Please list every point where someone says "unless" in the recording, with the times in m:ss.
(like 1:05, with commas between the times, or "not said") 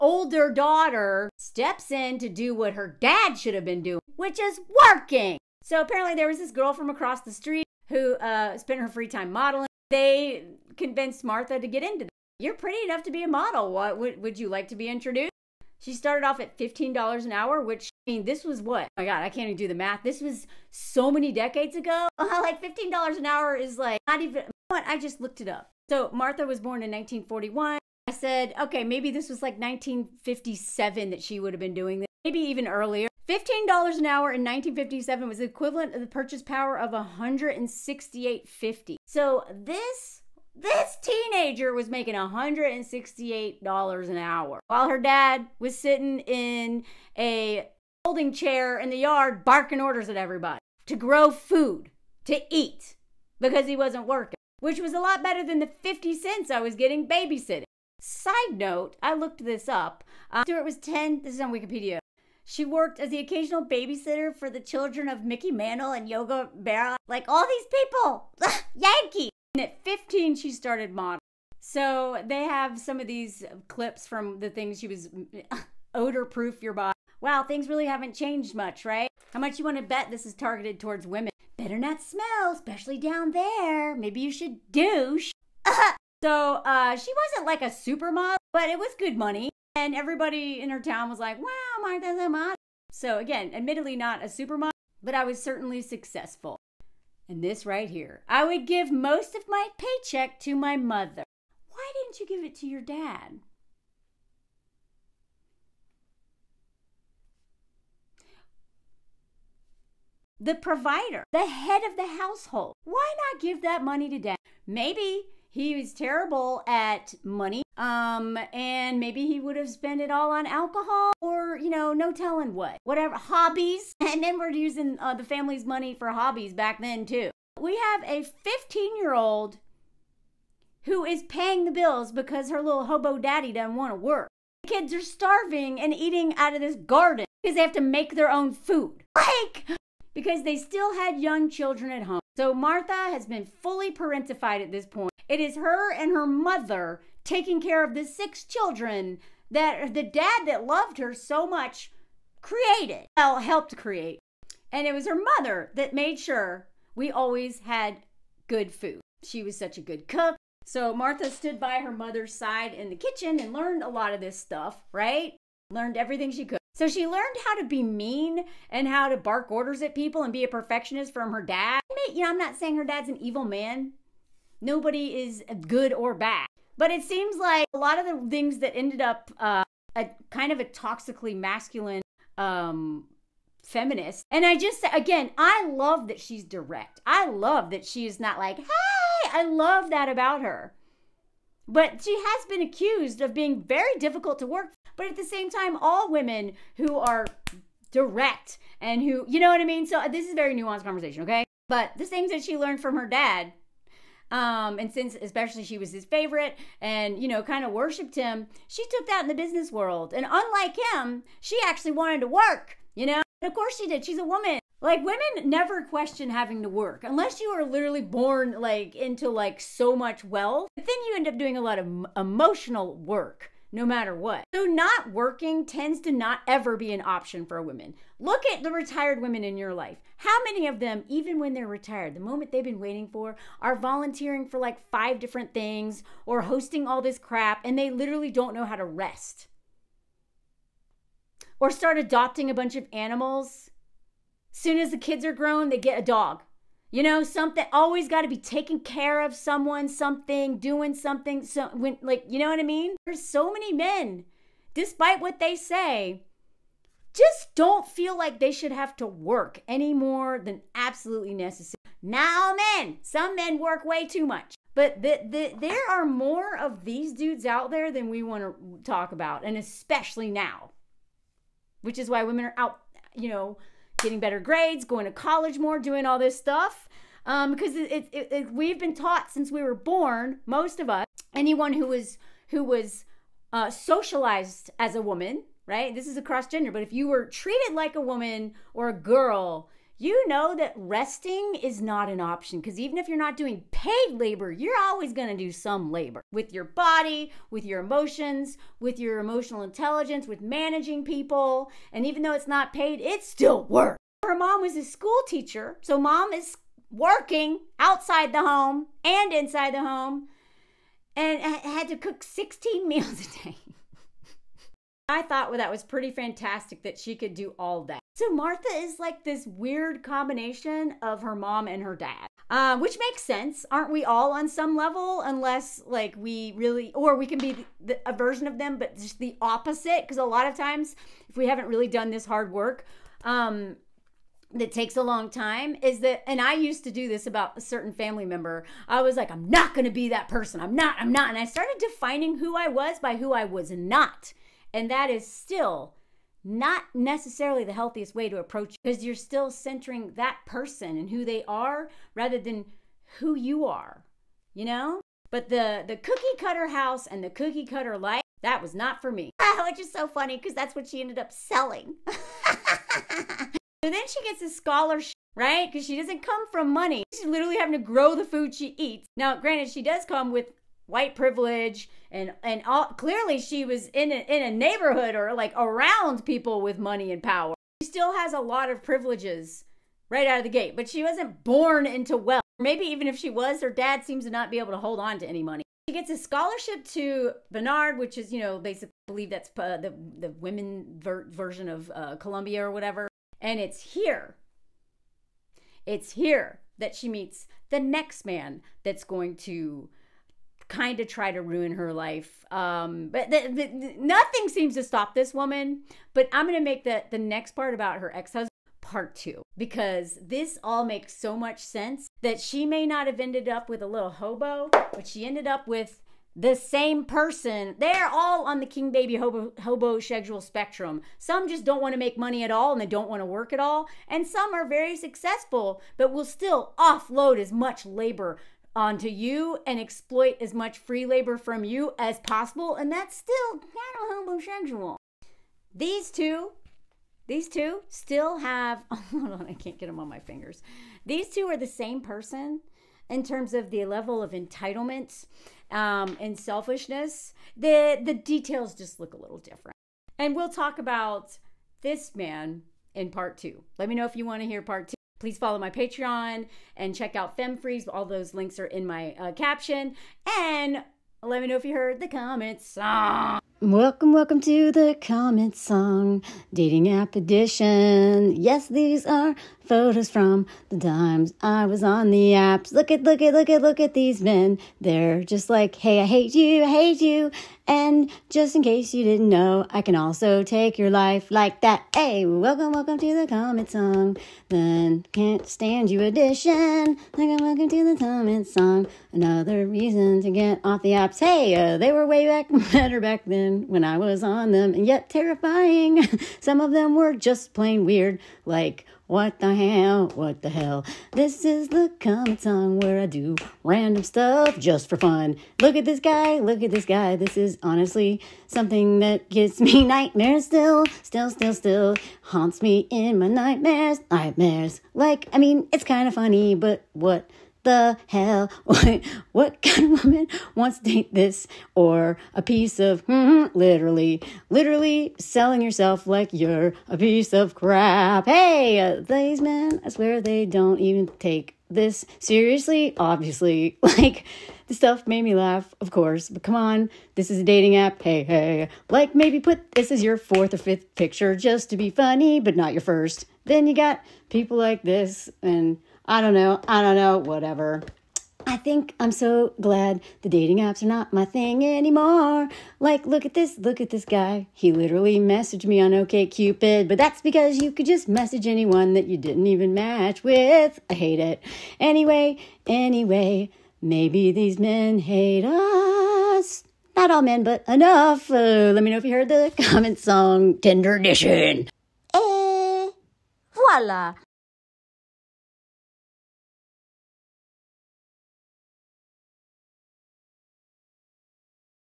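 3:37, 5:25.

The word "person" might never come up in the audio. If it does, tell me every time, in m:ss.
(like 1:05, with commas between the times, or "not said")
5:40, 5:50, 6:57, 7:22.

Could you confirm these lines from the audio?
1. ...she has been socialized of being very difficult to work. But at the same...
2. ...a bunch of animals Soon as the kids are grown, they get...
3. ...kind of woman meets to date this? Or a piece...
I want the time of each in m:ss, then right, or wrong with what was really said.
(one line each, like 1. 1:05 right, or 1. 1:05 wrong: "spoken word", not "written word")
1. 3:12 wrong: "accused", not "socialized"
2. 4:02 right
3. 8:39 wrong: "wants", not "meets".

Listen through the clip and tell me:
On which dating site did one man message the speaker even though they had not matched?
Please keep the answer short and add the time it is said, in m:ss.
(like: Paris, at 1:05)
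OKCupid, at 9:15.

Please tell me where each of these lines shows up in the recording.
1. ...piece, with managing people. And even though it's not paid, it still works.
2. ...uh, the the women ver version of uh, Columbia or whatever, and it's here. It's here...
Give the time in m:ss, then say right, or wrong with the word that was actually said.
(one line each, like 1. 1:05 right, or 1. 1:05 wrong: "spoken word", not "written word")
1. 4:59 wrong: "intelligence", not "piece"
2. 6:29 right.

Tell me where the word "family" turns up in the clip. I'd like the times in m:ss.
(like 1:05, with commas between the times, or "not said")
2:05, 5:37.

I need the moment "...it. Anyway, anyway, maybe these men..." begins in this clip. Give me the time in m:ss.
9:21.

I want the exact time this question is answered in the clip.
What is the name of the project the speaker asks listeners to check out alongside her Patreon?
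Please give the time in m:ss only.
7:37.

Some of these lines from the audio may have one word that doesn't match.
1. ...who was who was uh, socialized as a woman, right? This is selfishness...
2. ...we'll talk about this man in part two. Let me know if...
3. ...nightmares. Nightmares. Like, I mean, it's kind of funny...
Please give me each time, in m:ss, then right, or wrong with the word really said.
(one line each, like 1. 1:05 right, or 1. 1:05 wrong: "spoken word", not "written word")
1. 4:41 wrong: "across", not "selfishness"
2. 7:30 right
3. 8:33 right.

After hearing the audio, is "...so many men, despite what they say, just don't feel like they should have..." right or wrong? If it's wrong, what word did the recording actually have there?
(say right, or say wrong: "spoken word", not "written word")
right.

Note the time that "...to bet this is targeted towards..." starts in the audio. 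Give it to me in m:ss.
1:19.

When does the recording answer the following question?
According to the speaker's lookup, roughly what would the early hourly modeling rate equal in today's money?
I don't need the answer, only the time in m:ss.
0:36.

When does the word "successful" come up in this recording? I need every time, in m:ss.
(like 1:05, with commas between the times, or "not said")
1:35, 7:04.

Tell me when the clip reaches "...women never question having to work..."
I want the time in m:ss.
3:35.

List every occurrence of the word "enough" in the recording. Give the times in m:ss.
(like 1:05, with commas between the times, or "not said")
0:12, 9:27.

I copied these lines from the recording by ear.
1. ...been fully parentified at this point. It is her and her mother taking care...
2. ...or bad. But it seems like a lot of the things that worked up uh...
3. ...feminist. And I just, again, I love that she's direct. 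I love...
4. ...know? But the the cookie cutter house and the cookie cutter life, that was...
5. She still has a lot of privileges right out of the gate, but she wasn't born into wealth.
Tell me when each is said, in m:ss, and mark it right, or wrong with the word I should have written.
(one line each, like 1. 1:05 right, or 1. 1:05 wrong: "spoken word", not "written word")
1. 2:23 right
2. 2:55 wrong: "ended", not "worked"
3. 3:03 right
4. 5:54 right
5. 6:17 right.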